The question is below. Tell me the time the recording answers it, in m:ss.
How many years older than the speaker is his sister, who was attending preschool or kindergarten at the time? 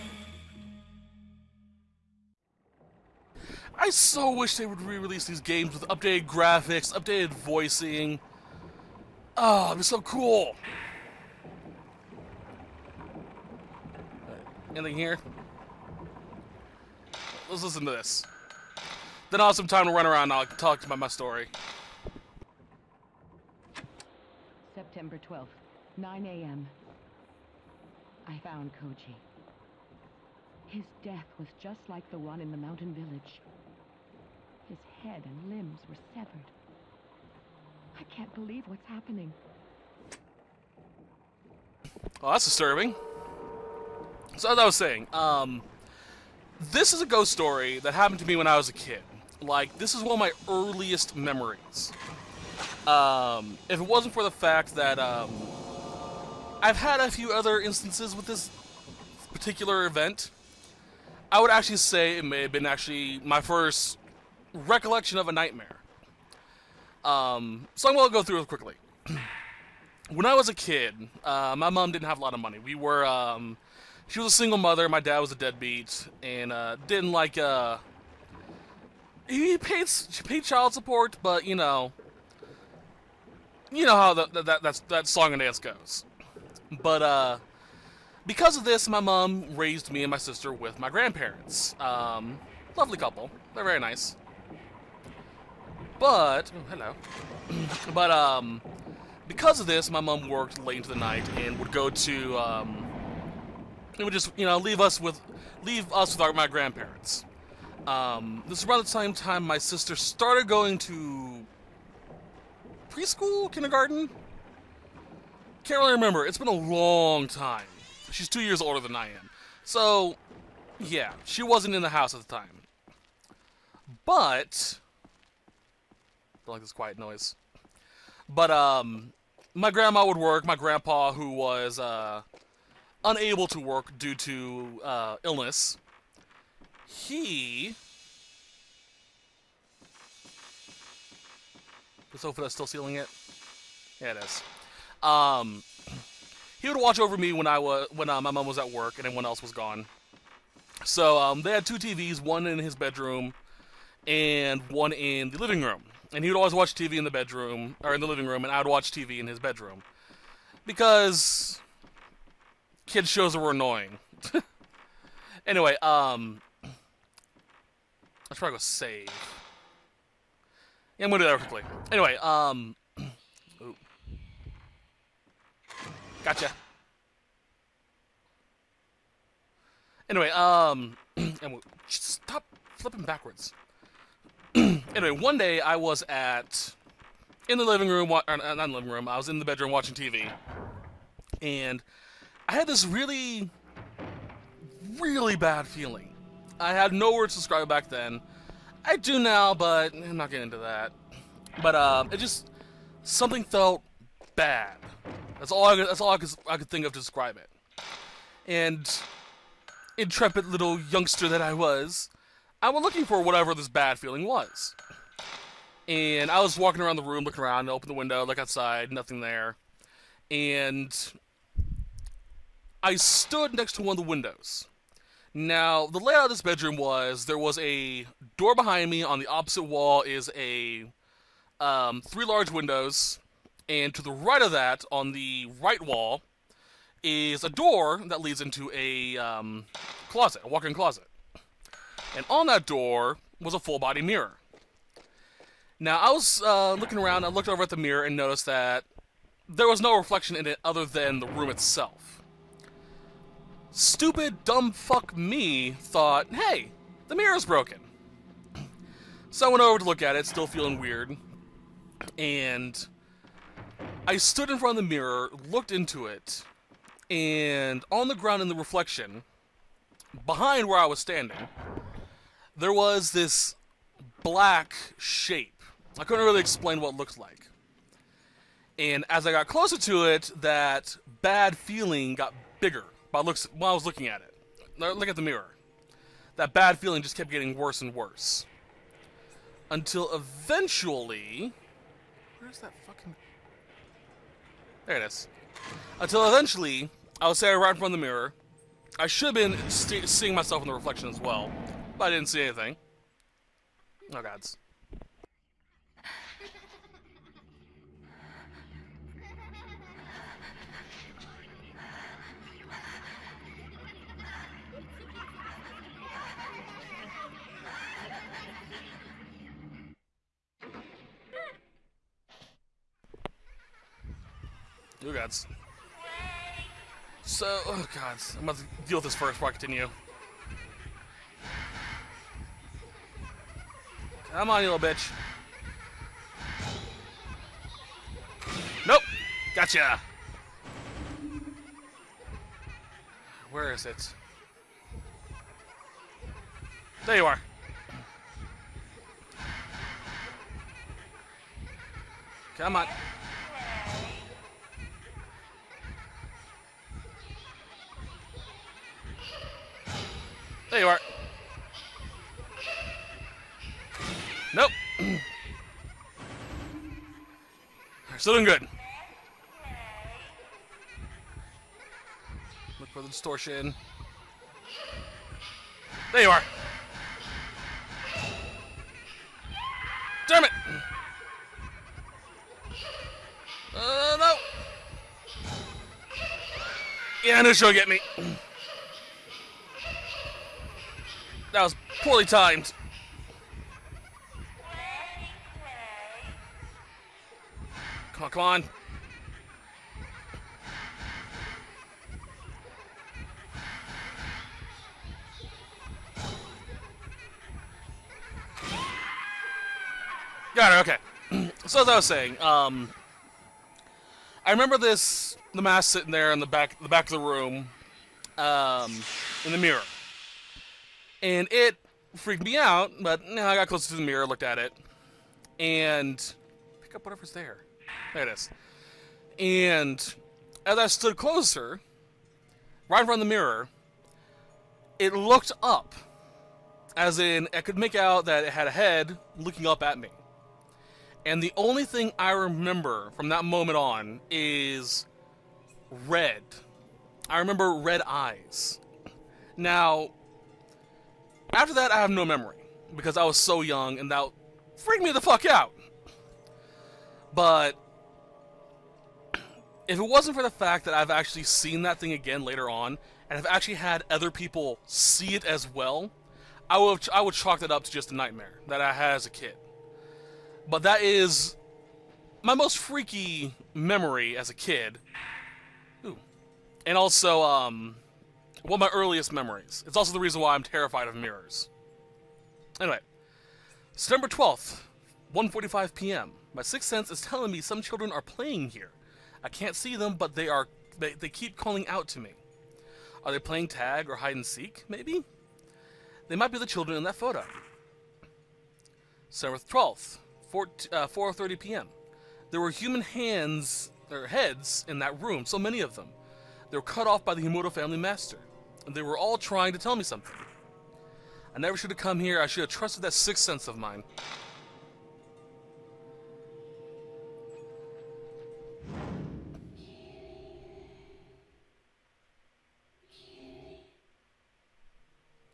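1:58.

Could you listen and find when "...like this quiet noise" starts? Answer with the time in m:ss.
2:06.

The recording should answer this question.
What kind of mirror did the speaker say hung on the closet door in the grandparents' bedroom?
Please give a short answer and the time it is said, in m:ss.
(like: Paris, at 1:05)
Full body mirror, at 4:03.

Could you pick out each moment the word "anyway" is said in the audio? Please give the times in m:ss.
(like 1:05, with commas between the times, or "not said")
2:45, 2:51, 3:00, 3:04, 8:02.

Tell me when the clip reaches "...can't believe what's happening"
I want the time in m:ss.
0:38.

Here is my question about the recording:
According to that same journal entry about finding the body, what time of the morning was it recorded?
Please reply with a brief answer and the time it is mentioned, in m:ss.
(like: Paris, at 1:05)
9 a.m., at 0:25.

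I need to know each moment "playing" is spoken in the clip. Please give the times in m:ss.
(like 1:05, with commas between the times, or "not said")
8:08, 8:13.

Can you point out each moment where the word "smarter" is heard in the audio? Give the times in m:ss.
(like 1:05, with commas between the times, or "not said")
not said.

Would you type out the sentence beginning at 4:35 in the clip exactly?
I couldn't really explain what it looked like.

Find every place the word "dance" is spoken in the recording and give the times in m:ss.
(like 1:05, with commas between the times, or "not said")
1:25.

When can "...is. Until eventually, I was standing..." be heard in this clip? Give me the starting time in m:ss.
4:55.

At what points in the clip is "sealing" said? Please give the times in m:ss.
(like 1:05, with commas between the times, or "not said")
2:22.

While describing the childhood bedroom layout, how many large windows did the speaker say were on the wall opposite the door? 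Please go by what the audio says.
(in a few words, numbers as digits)
3.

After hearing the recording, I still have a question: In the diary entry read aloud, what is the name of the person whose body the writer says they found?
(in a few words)
Koji.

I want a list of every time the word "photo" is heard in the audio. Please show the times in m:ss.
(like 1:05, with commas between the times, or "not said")
8:17.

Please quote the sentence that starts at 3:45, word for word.
Now, the layout of this bedroom was there was a door behind me.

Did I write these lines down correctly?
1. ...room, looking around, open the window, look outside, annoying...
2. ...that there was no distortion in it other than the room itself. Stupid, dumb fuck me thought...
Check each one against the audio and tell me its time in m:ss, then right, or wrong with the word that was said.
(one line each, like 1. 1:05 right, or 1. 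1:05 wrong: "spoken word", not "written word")
1. 3:37 wrong: "nothing", not "annoying"
2. 4:08 wrong: "reflection", not "distortion".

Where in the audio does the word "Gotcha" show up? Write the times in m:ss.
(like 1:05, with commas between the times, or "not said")
2:56, 5:39.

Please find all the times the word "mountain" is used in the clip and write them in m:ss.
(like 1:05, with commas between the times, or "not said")
0:32.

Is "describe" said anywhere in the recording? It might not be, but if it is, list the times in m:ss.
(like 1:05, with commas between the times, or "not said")
3:17, 3:27.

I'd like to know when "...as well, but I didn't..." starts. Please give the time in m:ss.
5:01.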